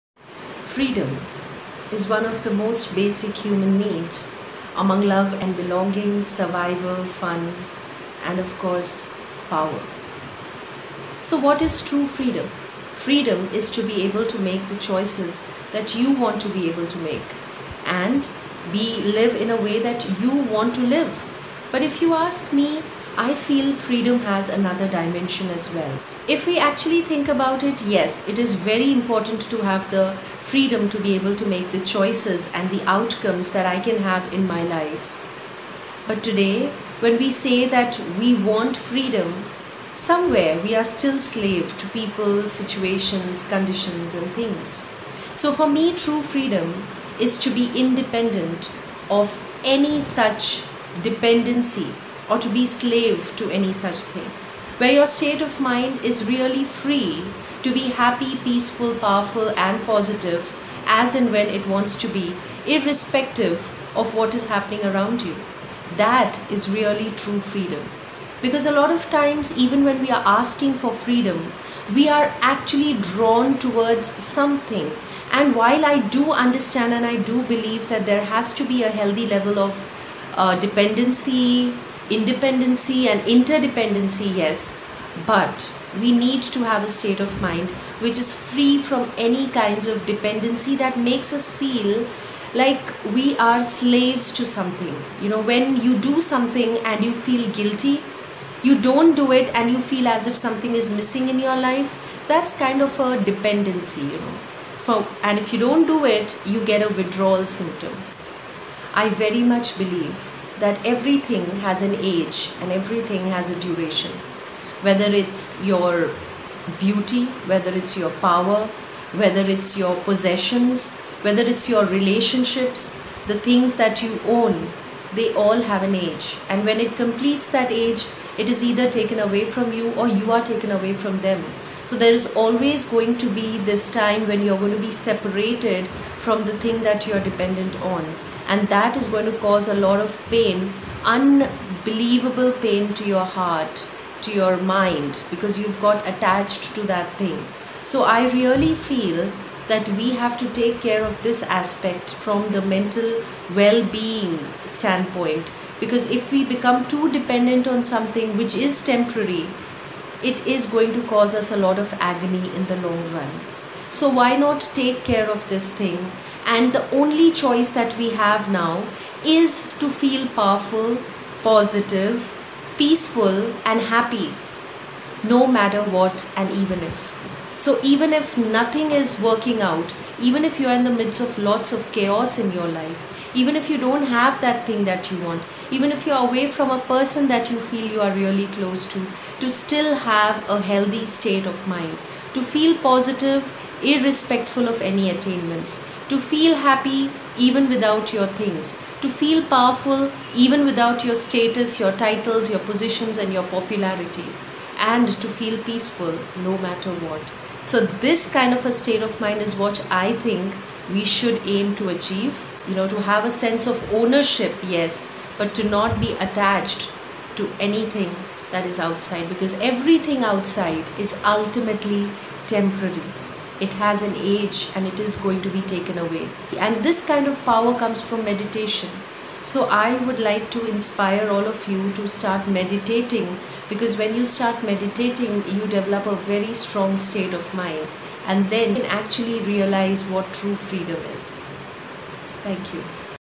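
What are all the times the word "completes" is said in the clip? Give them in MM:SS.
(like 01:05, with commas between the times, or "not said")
02:06.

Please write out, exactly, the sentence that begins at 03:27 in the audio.
So, this kind of a state of mind is what I think we should aim to achieve.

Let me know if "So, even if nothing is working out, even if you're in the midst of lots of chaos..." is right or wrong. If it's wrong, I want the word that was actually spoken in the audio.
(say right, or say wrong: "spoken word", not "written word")
right.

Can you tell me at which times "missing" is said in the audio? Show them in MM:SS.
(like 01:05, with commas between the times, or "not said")
01:40.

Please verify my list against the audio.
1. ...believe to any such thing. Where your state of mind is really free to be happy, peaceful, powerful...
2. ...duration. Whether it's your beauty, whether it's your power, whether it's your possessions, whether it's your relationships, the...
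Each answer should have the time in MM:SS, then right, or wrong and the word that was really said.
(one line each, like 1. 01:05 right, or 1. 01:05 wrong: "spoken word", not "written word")
1. 00:52 wrong: "slave", not "believe"
2. 01:53 right.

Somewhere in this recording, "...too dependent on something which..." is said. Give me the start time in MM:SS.
02:36.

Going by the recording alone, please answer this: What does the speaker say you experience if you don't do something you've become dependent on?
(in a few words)
A withdrawal symptom.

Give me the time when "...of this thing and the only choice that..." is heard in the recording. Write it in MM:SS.
02:45.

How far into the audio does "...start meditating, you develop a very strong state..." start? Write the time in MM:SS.
03:54.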